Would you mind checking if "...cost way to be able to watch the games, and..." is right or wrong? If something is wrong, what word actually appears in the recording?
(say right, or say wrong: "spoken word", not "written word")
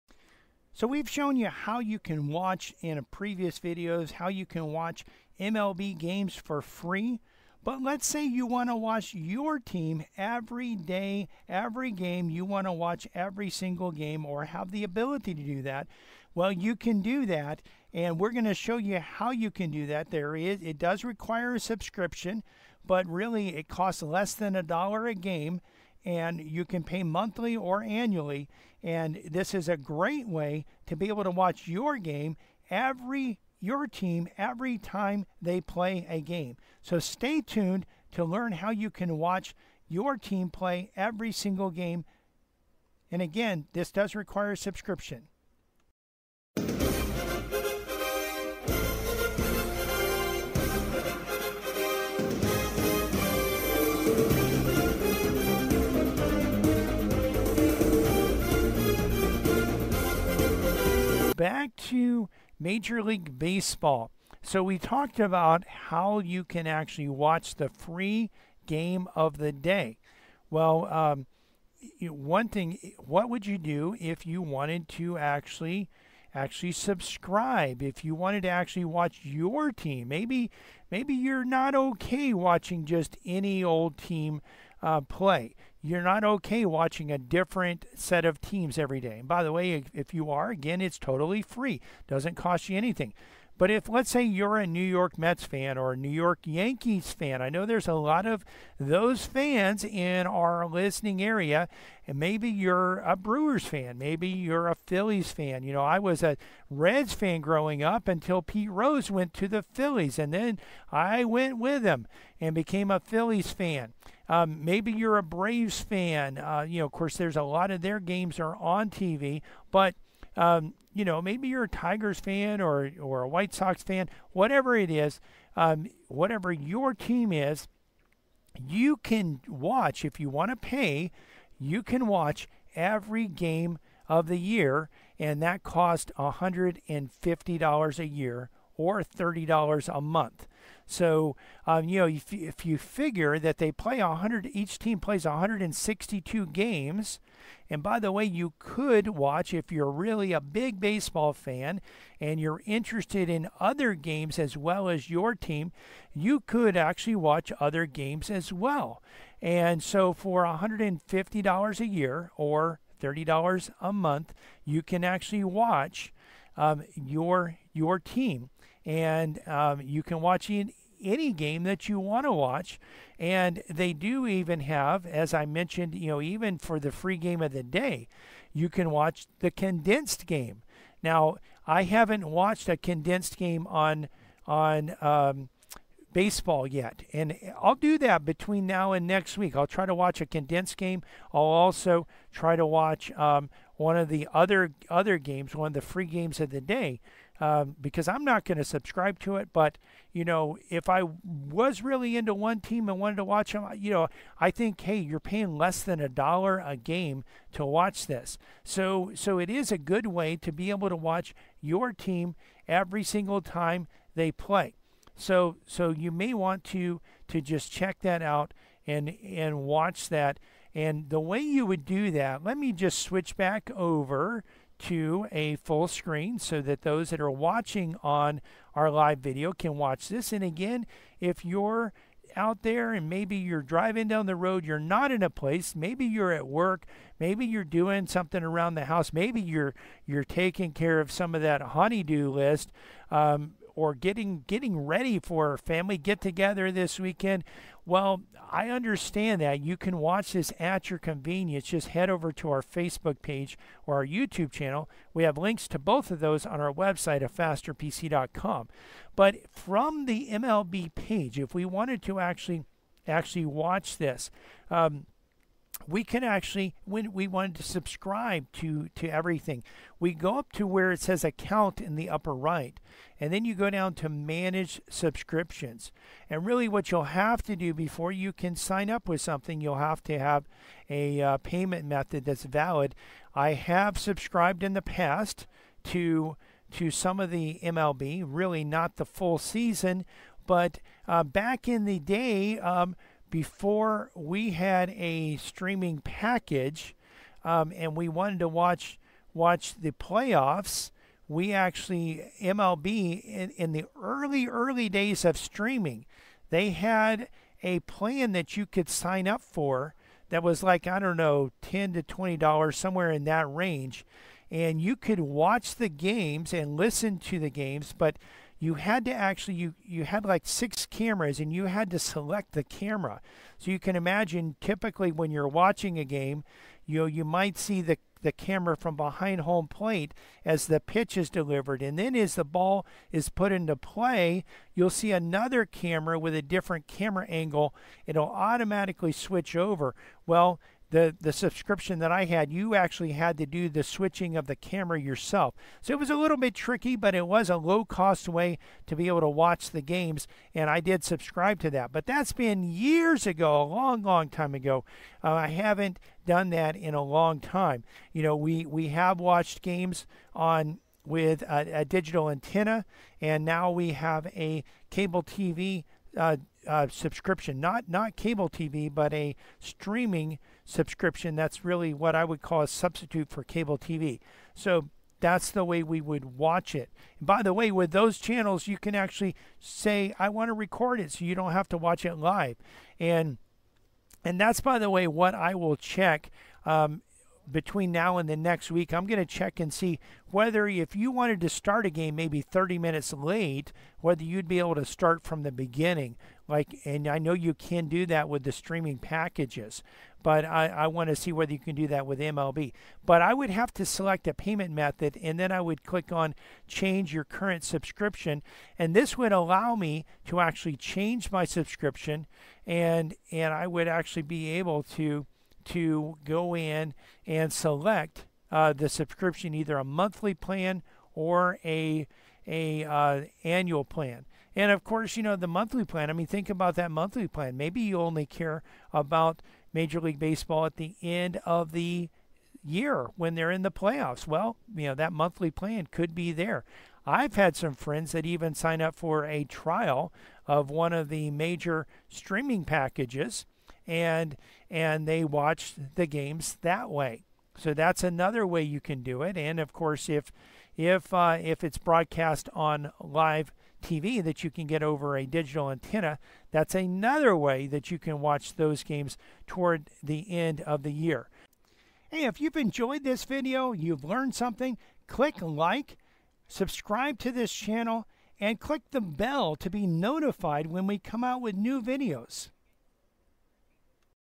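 right.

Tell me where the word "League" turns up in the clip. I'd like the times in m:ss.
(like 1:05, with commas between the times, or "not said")
1:03, 7:10.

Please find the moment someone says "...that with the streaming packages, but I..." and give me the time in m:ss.
6:38.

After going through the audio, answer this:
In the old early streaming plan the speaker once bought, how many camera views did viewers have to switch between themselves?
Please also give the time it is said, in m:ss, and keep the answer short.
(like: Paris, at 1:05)
6, at 5:20.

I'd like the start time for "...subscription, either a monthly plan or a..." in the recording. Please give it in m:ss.
6:58.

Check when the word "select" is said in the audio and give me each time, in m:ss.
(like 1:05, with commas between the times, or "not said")
5:21, 6:43, 6:57.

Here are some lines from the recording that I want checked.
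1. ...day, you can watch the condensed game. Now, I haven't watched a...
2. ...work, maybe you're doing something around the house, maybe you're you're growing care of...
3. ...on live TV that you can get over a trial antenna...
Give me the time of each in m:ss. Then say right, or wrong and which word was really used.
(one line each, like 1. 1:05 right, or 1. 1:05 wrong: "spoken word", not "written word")
1. 2:57 right
2. 3:56 wrong: "taking", not "growing"
3. 7:32 wrong: "digital", not "trial".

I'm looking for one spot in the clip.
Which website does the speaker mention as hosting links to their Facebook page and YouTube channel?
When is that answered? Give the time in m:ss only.
4:17.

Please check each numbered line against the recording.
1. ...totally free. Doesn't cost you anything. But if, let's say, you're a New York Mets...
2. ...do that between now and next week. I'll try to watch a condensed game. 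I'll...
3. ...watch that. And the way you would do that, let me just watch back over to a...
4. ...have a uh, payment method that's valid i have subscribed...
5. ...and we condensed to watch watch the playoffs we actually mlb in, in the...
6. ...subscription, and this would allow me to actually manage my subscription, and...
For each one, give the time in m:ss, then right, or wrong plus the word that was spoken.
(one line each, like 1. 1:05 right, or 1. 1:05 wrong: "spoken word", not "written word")
1. 1:30 right
2. 3:07 right
3. 3:39 wrong: "switch", not "watch"
4. 4:40 right
5. 4:57 wrong: "wanted", not "condensed"
6. 6:47 wrong: "change", not "manage".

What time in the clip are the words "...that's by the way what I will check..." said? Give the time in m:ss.
6:24.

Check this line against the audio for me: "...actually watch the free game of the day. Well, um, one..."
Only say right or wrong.
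right.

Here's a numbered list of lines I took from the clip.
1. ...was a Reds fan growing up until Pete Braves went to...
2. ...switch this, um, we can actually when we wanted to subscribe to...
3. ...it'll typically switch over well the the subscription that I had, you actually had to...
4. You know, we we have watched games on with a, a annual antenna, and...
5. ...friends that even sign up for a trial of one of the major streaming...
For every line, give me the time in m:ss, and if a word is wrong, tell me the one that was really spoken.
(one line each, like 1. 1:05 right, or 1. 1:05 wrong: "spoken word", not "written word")
1. 1:45 wrong: "Rose", not "Braves"
2. 4:23 wrong: "watch", not "switch"
3. 5:38 wrong: "automatically", not "typically"
4. 5:58 wrong: "digital", not "annual"
5. 7:17 right.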